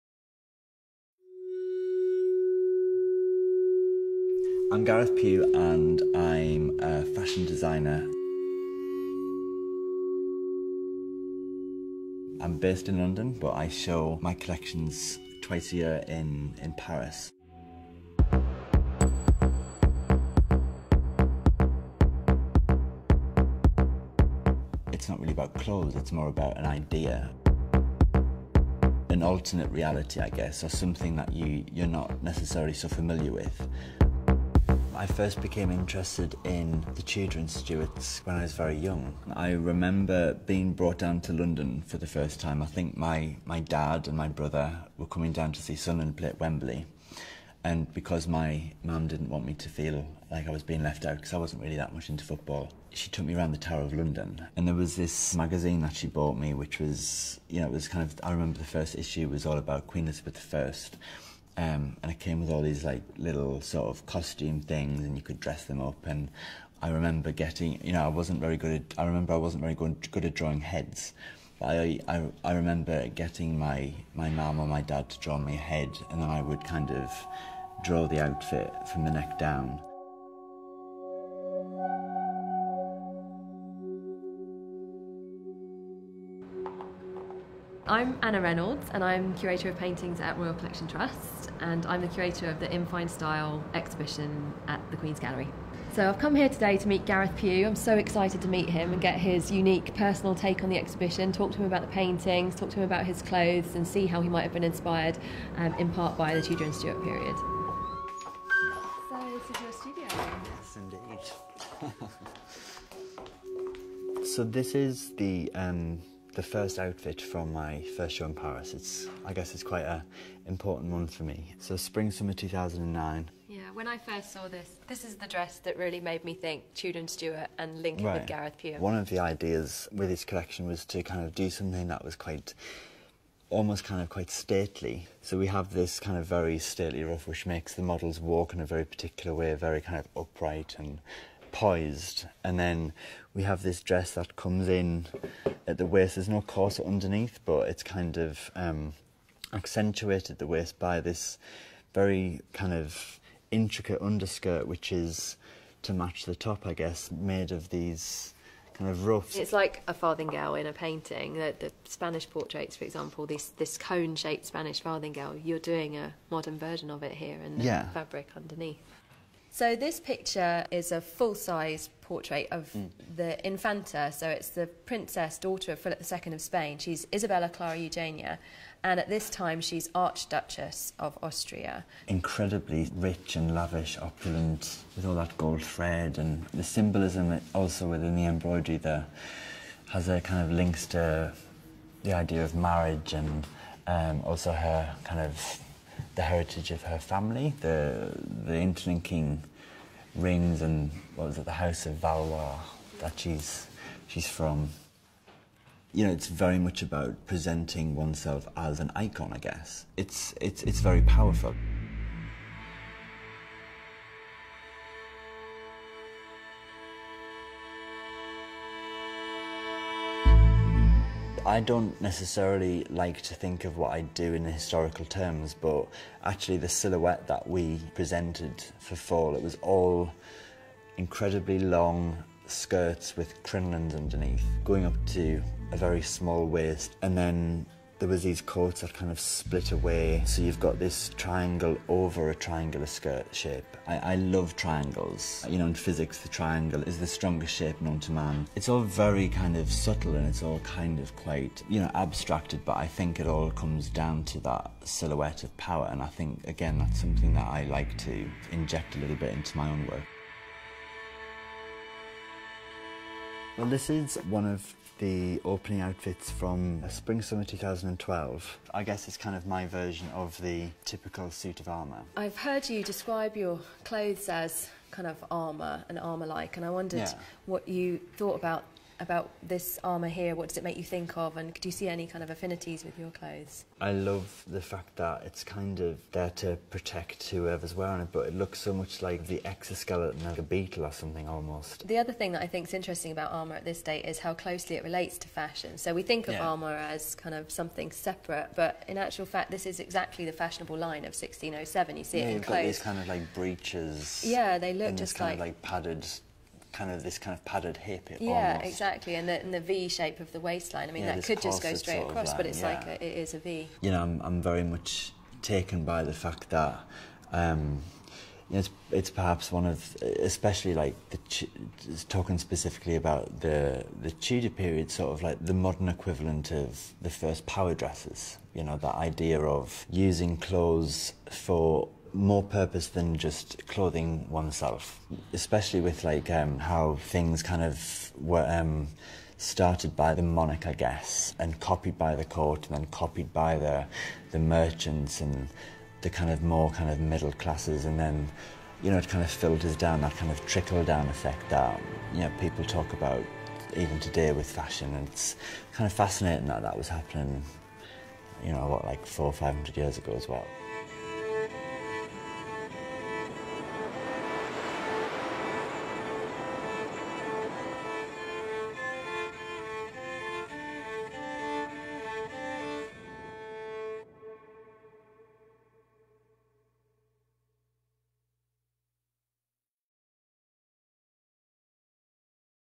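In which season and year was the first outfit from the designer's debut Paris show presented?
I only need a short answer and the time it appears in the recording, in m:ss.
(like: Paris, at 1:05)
spring summer 2009, at 2:01.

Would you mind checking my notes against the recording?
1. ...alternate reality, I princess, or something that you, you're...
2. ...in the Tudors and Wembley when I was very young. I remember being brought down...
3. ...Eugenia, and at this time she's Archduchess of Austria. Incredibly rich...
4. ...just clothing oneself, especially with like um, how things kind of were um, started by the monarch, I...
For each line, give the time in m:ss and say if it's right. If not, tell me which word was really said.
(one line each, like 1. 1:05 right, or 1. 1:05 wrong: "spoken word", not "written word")
1. 0:29 wrong: "guess", not "princess"
2. 0:36 wrong: "Stuarts", not "Wembley"
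3. 2:57 right
4. 5:33 right.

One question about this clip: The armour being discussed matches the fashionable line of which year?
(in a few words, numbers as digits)
1607.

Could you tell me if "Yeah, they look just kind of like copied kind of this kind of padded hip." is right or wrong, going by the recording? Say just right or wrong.
wrong.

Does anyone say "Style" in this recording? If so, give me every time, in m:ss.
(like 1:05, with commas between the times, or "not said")
1:33.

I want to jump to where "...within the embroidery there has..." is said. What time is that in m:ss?
3:07.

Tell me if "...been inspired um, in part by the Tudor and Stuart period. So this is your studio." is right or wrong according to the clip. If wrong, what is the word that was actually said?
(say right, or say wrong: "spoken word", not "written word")
right.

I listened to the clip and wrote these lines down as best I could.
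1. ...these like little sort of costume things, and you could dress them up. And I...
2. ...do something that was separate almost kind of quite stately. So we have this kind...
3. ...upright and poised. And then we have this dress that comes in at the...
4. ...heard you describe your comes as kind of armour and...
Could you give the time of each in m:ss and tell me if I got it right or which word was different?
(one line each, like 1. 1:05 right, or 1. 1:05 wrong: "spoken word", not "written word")
1. 1:02 right
2. 2:11 wrong: "quite", not "separate"
3. 2:20 right
4. 4:32 wrong: "clothes", not "comes".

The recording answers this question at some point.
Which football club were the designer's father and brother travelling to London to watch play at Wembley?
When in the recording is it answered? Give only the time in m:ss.
0:45.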